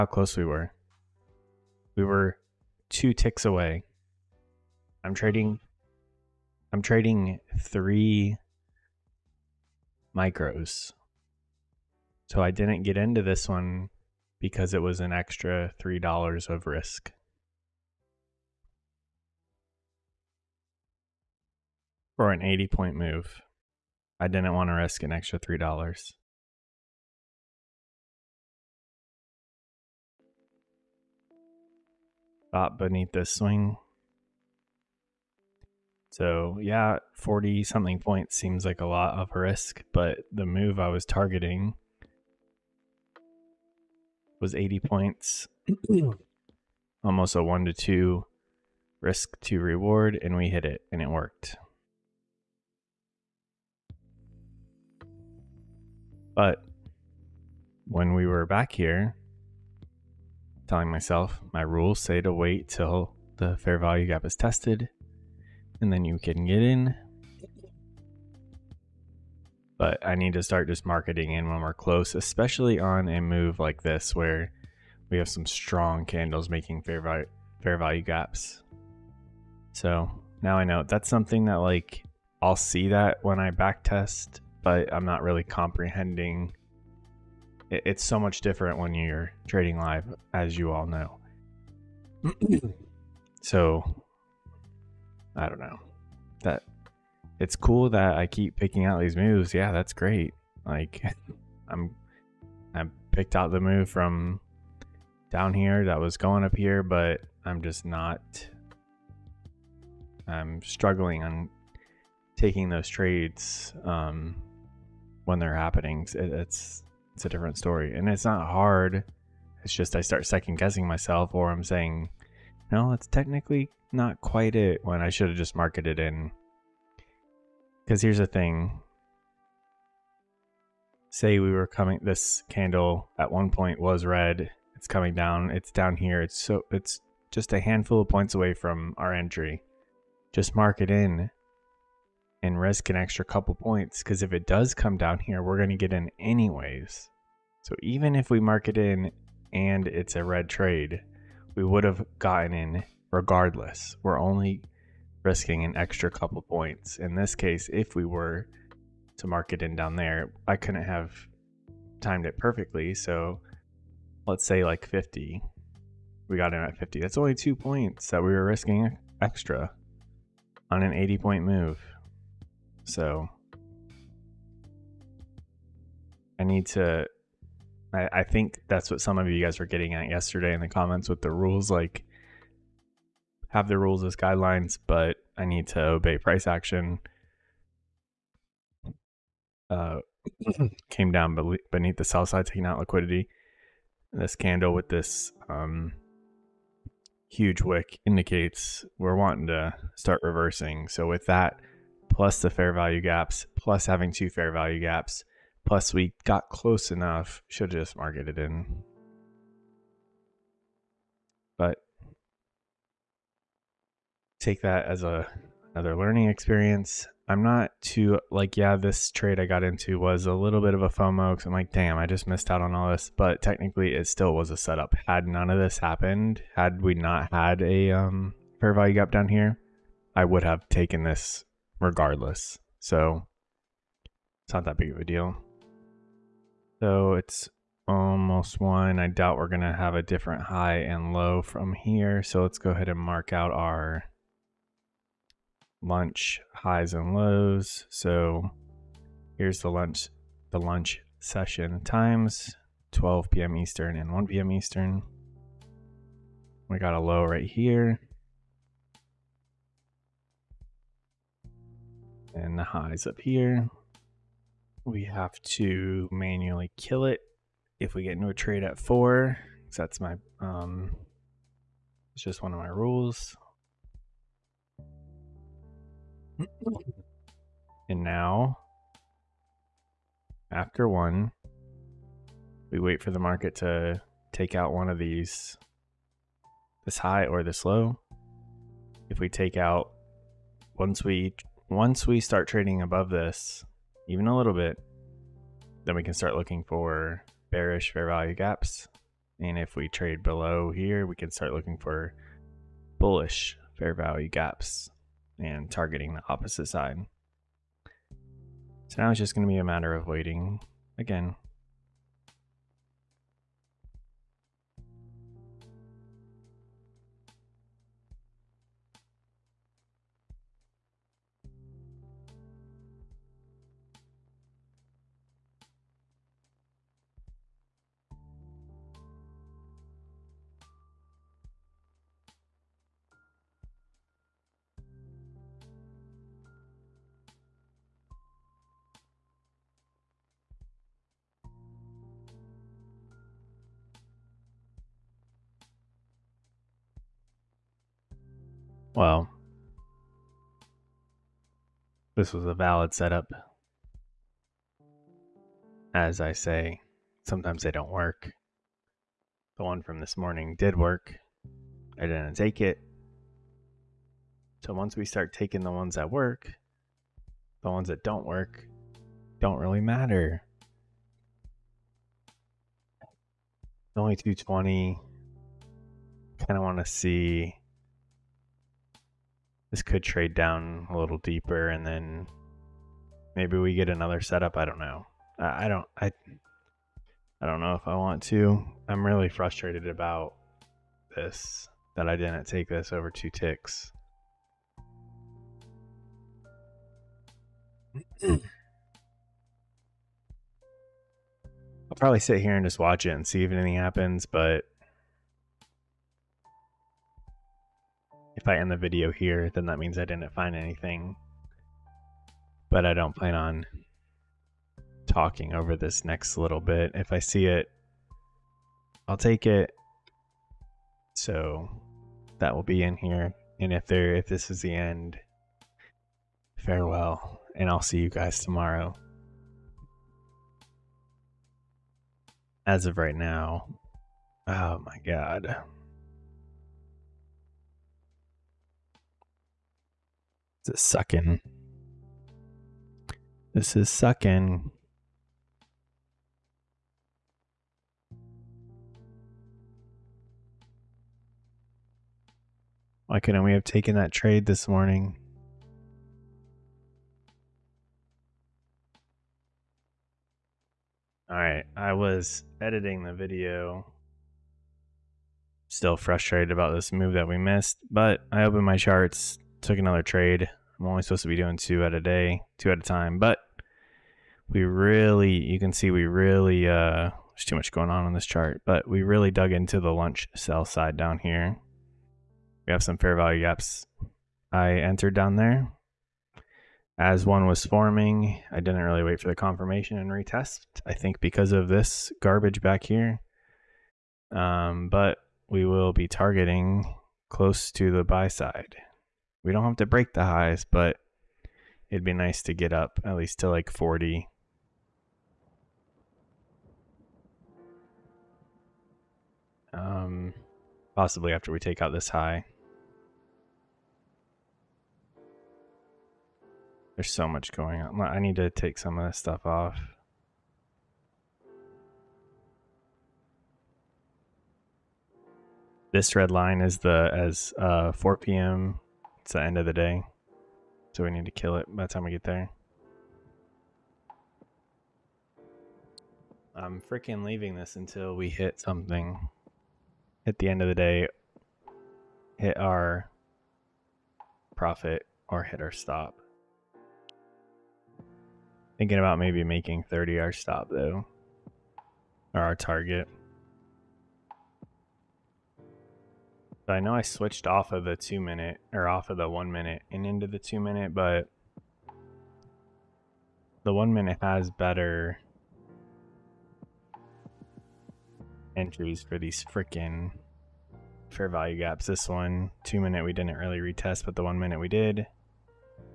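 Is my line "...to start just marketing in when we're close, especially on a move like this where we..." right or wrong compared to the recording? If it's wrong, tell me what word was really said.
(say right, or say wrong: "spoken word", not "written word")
right.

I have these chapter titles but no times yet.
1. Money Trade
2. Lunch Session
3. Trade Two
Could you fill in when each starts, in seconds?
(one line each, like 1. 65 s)
1. 460 s
2. 235 s
3. 311 s.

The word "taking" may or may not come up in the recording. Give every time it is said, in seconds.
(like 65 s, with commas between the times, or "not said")
112 s, 192 s, 365 s.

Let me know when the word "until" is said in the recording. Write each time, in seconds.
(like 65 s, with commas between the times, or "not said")
537 s.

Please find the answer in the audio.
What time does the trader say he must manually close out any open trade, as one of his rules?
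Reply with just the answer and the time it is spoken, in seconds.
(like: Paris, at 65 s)
4, at 268 s.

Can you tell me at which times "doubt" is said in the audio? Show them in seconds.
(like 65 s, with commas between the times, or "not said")
239 s.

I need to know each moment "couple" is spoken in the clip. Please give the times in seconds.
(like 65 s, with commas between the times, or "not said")
143 s, 156 s.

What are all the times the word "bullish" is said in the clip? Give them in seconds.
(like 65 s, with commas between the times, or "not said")
302 s.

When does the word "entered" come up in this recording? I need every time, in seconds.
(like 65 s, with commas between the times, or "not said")
484 s.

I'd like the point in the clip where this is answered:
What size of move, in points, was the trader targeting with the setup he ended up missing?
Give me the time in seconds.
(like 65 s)
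44 s.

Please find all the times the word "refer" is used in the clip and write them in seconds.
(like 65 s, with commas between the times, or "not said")
not said.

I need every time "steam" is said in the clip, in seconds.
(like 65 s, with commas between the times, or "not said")
not said.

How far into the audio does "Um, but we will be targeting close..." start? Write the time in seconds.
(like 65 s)
494 s.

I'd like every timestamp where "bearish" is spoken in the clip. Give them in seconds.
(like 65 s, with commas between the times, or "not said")
297 s.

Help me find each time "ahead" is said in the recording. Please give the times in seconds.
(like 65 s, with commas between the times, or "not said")
242 s.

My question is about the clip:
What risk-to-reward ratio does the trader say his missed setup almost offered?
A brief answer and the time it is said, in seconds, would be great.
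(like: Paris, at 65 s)
1 to 2, at 47 s.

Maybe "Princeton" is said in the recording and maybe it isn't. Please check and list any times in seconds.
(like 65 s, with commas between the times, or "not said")
not said.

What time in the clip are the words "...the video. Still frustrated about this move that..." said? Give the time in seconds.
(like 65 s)
463 s.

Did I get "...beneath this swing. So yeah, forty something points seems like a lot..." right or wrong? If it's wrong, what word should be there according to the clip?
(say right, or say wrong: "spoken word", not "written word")
right.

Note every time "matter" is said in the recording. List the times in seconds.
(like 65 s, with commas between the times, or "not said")
309 s, 369 s.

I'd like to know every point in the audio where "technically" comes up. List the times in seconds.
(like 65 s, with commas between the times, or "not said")
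123 s, 223 s.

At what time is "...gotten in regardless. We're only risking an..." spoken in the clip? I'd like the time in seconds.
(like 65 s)
152 s.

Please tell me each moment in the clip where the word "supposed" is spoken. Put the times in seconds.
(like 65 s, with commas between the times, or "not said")
471 s.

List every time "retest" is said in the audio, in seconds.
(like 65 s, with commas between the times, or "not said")
490 s, 573 s.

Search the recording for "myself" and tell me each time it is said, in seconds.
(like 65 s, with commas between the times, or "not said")
60 s, 120 s.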